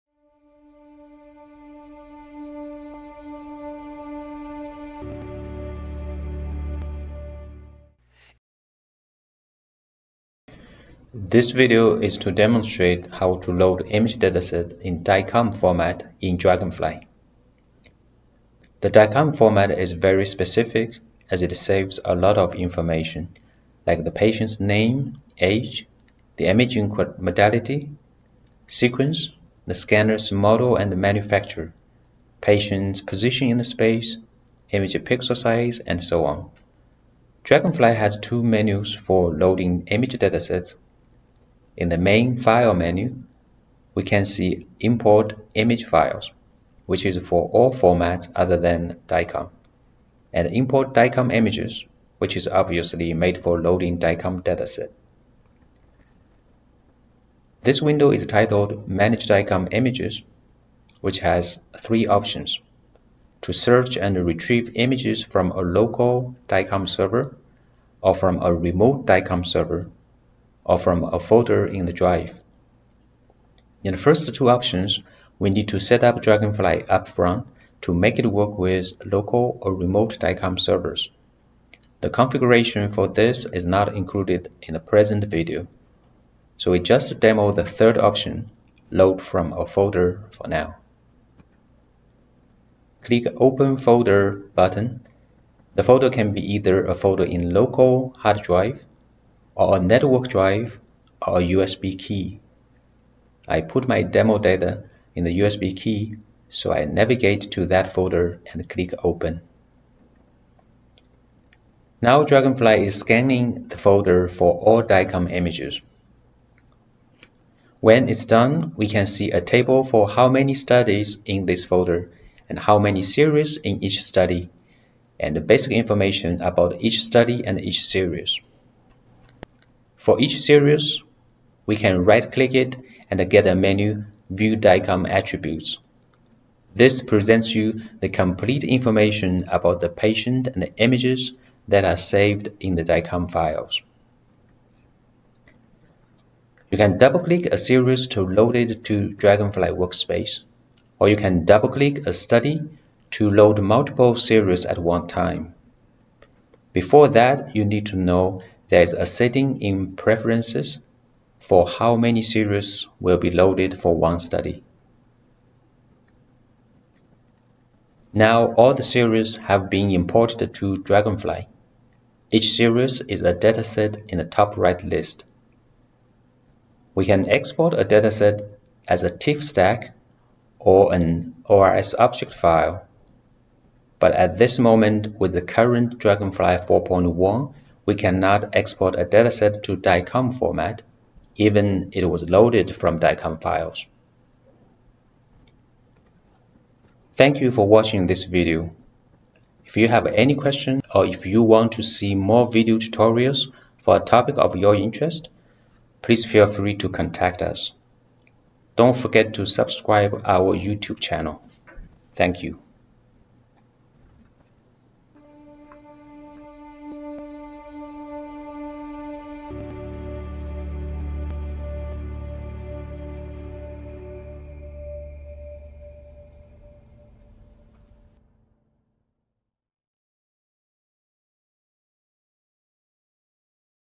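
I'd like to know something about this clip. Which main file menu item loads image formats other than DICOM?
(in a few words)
Import image files.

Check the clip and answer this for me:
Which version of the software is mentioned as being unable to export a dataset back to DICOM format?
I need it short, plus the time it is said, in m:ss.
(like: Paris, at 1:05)
Dragonfly 4.1, at 3:05.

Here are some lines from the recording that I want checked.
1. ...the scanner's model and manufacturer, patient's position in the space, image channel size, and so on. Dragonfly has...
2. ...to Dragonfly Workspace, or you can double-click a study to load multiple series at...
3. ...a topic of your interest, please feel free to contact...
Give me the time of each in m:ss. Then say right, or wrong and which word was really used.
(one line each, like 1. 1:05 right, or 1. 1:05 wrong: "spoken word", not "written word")
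1. 0:29 wrong: "pixel", not "channel"
2. 2:28 right
3. 3:23 right.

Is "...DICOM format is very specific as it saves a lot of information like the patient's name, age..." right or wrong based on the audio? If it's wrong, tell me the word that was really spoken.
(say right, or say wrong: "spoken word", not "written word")
right.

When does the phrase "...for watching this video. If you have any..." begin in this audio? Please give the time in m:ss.
3:17.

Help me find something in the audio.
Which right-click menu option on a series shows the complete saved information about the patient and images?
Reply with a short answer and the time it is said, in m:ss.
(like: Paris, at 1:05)
View DICOM Attributes, at 2:14.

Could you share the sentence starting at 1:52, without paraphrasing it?
Now Dragonfly is scanning the folder for all DICOM images.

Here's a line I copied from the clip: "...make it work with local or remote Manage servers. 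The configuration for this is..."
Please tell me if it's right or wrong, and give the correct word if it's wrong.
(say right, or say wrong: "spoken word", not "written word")
wrong: "DICOM", not "Manage".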